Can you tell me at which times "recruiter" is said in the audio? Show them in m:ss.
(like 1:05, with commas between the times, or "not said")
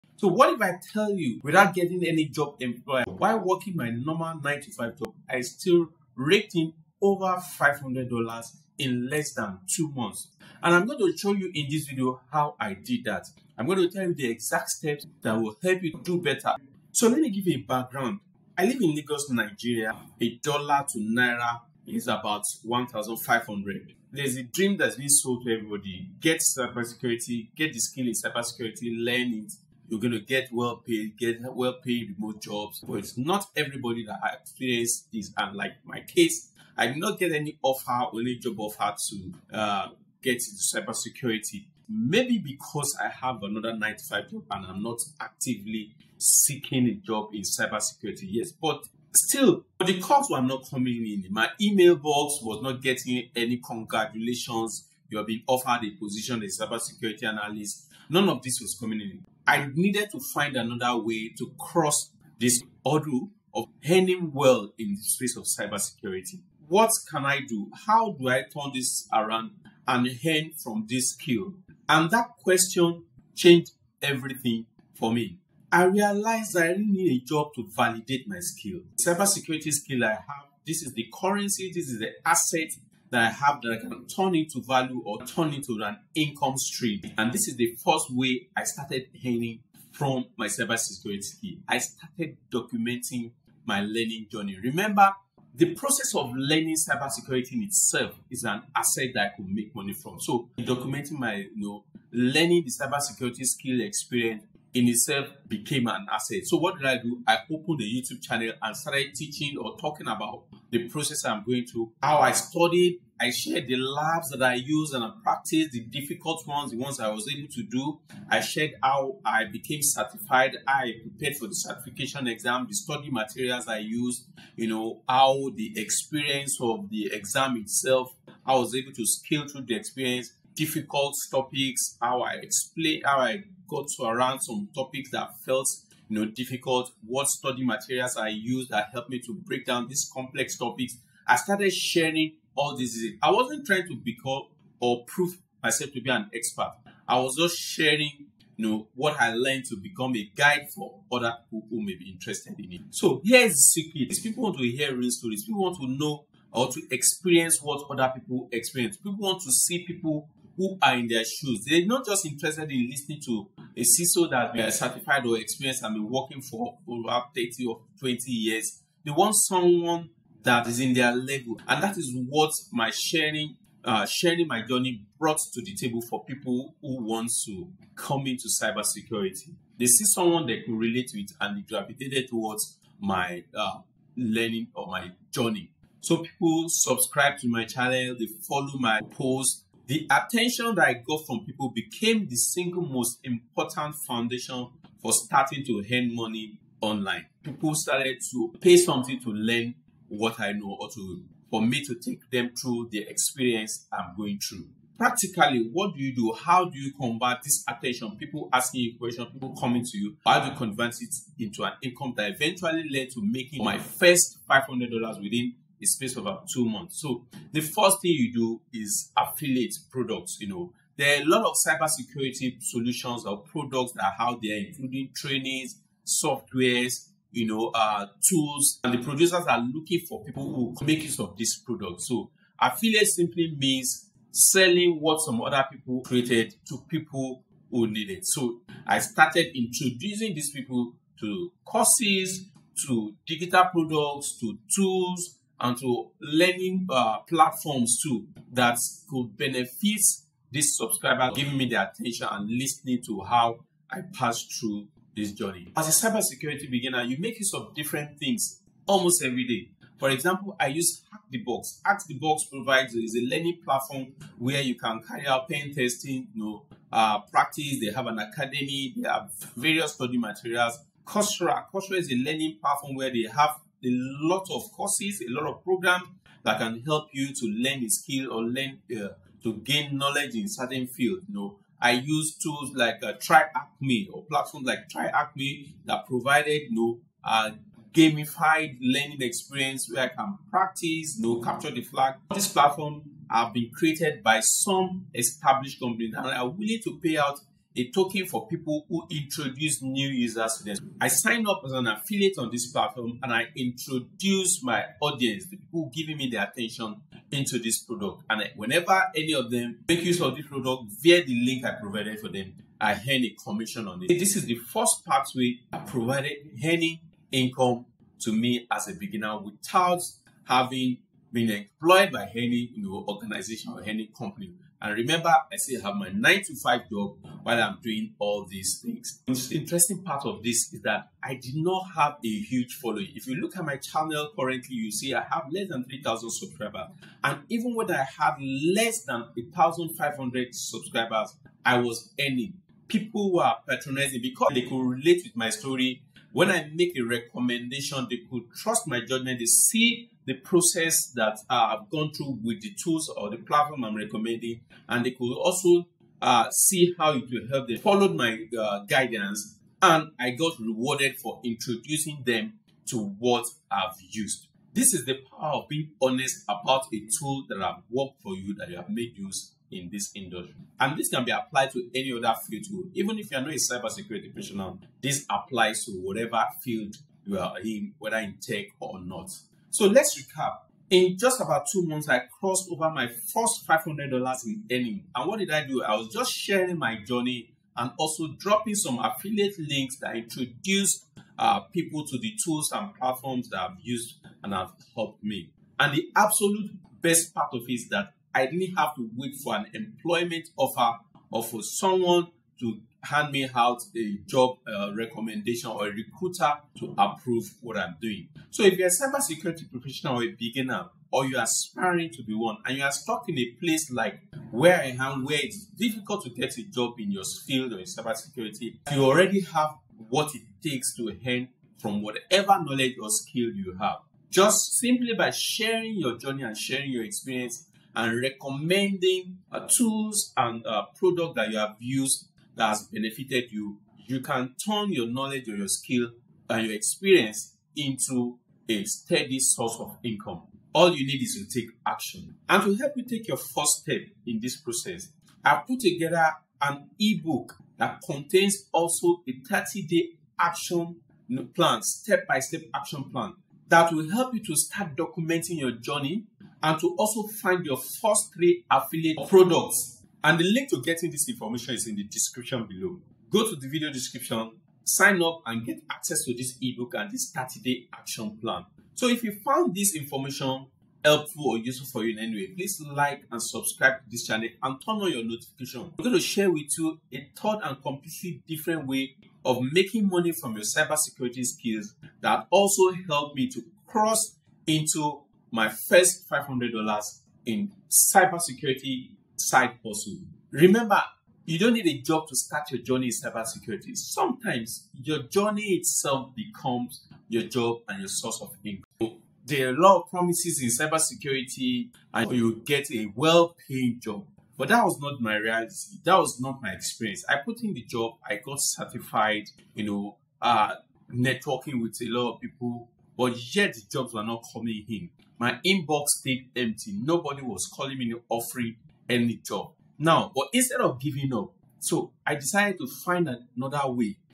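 6:45.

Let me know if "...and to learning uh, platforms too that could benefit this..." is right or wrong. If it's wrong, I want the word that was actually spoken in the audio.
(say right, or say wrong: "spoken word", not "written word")
right.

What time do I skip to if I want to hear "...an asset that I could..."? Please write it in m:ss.
1:38.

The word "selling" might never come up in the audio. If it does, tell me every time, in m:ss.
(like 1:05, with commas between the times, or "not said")
3:54.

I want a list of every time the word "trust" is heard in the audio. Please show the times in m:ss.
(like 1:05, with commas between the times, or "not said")
5:48.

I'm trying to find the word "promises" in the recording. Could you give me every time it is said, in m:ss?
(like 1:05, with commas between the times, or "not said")
8:20.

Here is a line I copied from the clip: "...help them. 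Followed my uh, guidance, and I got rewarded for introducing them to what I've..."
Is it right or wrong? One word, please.
right.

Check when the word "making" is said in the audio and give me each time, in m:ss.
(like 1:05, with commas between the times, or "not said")
3:33, 7:59.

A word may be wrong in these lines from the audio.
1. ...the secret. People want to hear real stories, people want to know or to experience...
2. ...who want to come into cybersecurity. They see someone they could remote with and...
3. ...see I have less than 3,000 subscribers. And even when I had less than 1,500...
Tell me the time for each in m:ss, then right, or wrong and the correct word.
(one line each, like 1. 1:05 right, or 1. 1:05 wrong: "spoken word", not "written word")
1. 2:33 right
2. 2:56 wrong: "relate", not "remote"
3. 5:34 right.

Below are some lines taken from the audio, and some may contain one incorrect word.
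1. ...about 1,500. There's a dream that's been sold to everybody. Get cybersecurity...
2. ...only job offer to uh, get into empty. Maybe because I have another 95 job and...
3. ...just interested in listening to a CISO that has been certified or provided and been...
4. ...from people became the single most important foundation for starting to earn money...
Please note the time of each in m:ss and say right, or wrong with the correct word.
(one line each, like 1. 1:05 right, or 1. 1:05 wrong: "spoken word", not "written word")
1. 0:22 right
2. 0:38 wrong: "cybersecurity", not "empty"
3. 2:42 wrong: "experienced", not "provided"
4. 3:11 right.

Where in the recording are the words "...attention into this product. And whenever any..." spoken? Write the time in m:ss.
5:06.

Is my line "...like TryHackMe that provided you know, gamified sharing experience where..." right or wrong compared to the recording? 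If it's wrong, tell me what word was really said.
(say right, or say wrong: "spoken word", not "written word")
wrong: "learning", not "sharing".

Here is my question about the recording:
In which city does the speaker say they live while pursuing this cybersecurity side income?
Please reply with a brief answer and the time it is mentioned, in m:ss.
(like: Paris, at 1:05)
Lagos, at 0:18.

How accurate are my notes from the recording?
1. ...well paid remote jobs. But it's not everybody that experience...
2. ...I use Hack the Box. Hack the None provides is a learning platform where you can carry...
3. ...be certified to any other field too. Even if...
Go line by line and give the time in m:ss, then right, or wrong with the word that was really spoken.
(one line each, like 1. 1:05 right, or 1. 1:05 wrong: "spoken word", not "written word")
1. 0:31 right
2. 4:20 wrong: "Box", not "None"
3. 6:11 wrong: "applied", not "certified".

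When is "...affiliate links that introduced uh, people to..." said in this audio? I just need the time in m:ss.
6:28.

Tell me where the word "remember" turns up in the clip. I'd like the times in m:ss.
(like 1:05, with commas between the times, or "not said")
1:34, 5:24, 8:10.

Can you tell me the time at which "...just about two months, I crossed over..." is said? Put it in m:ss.
6:21.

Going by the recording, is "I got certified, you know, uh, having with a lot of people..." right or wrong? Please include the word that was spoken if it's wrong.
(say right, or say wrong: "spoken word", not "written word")
wrong: "networking", not "having".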